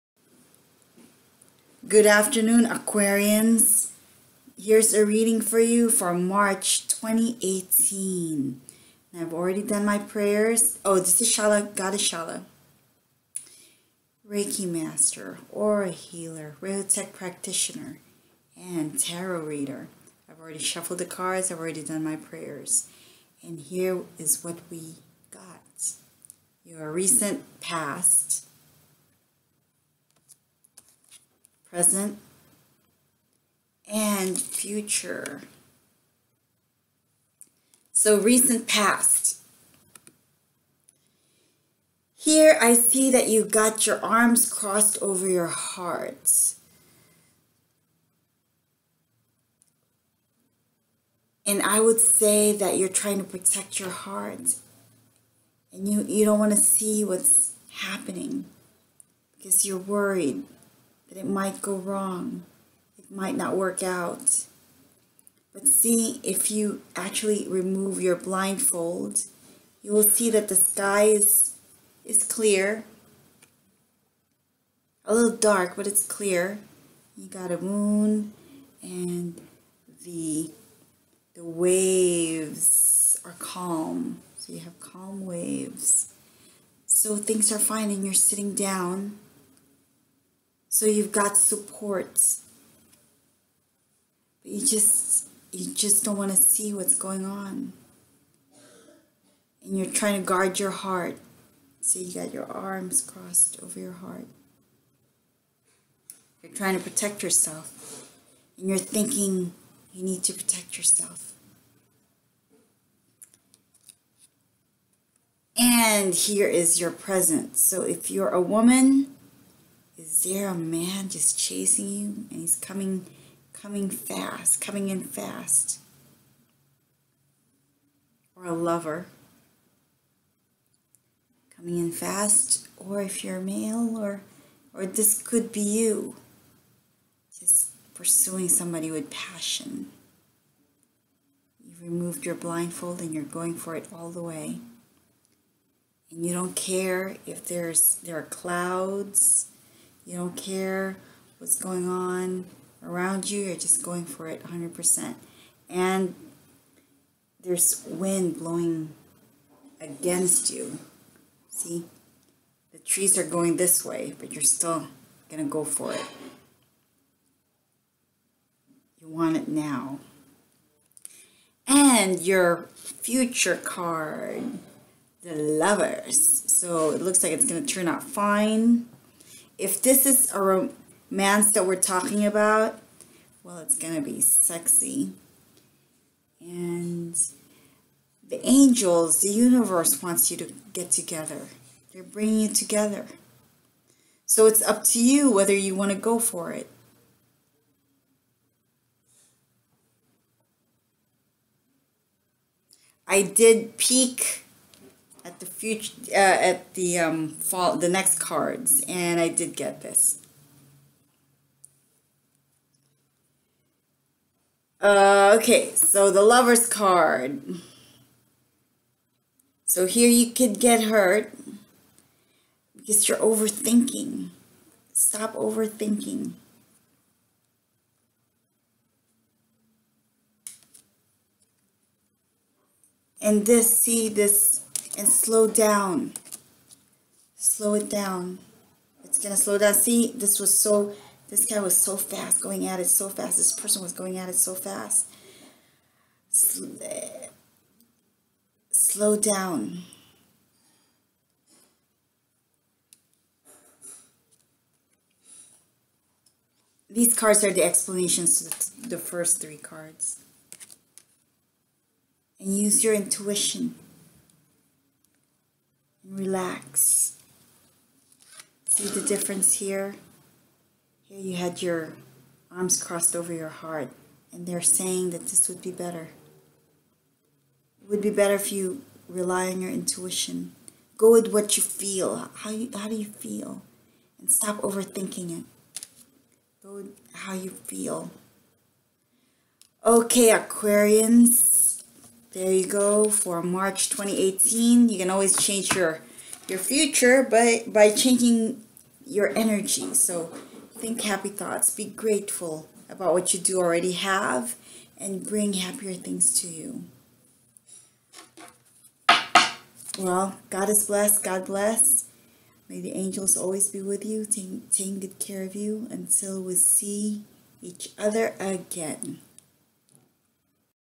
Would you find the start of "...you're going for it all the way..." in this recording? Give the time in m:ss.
2:23.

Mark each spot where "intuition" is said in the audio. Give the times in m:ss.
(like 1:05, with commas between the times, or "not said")
4:22, 4:39.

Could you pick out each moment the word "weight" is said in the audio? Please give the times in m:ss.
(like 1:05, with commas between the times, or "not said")
not said.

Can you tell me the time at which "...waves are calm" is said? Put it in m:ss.
1:21.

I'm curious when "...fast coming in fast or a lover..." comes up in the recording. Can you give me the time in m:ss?
2:03.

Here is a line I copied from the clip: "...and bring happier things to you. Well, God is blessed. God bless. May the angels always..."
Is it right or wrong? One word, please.
right.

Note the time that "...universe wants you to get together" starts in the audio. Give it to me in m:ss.
3:09.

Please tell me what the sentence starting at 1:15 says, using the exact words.
A little dark, but it's clear.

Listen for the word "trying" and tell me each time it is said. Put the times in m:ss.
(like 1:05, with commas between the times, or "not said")
0:52, 1:39, 1:46.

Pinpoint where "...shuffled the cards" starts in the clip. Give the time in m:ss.
0:20.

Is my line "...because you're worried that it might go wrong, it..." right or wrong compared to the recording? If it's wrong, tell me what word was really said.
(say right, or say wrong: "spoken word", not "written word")
right.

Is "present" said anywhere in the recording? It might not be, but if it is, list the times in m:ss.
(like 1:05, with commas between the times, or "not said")
0:31, 1:56.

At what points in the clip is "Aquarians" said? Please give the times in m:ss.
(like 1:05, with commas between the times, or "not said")
0:02, 4:50.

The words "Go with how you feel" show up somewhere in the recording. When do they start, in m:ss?
4:46.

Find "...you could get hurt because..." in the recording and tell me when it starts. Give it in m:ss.
3:40.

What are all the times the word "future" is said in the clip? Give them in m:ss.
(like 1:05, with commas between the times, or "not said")
0:34, 2:52, 3:25, 4:56.